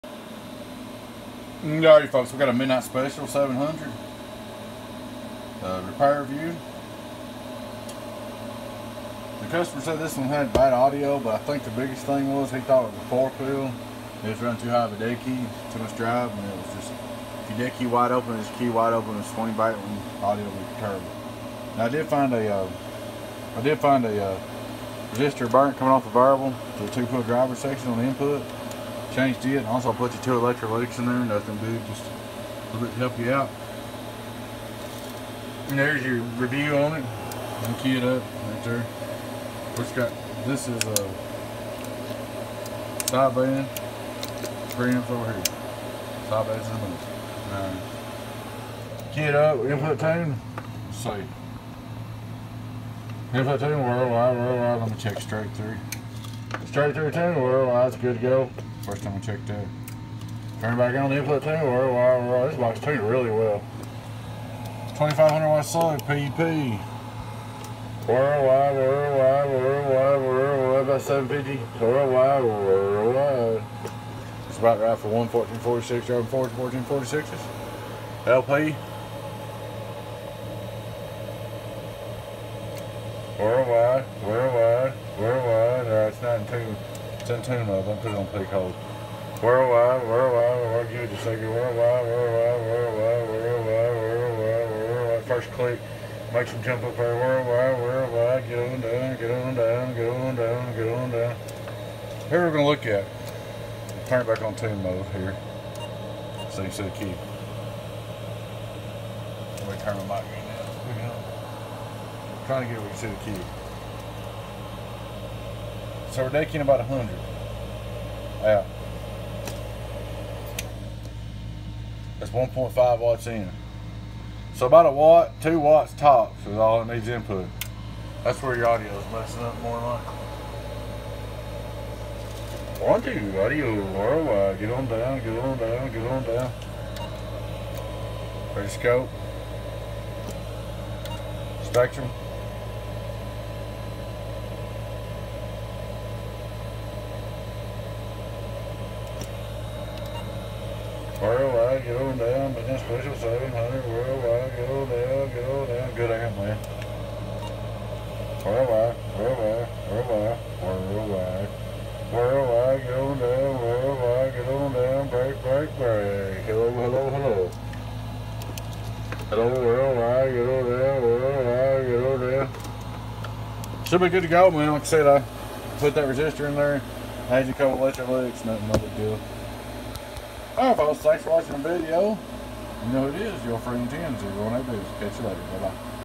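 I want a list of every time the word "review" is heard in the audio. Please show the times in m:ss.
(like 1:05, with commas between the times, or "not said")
0:06, 0:36.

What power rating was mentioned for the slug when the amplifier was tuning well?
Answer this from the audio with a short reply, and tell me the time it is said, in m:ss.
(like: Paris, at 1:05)
2500 watt, at 1:04.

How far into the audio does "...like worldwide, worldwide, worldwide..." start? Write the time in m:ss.
1:31.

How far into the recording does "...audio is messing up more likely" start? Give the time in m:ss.
2:08.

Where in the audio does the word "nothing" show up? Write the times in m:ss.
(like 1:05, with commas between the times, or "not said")
0:31, 2:58.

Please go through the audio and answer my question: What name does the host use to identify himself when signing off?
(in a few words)
Tinsy.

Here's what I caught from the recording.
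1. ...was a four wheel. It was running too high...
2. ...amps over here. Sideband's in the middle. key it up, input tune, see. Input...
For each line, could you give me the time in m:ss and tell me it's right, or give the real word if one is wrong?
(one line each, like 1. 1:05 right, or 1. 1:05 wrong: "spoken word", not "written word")
1. 0:12 right
2. 0:44 right.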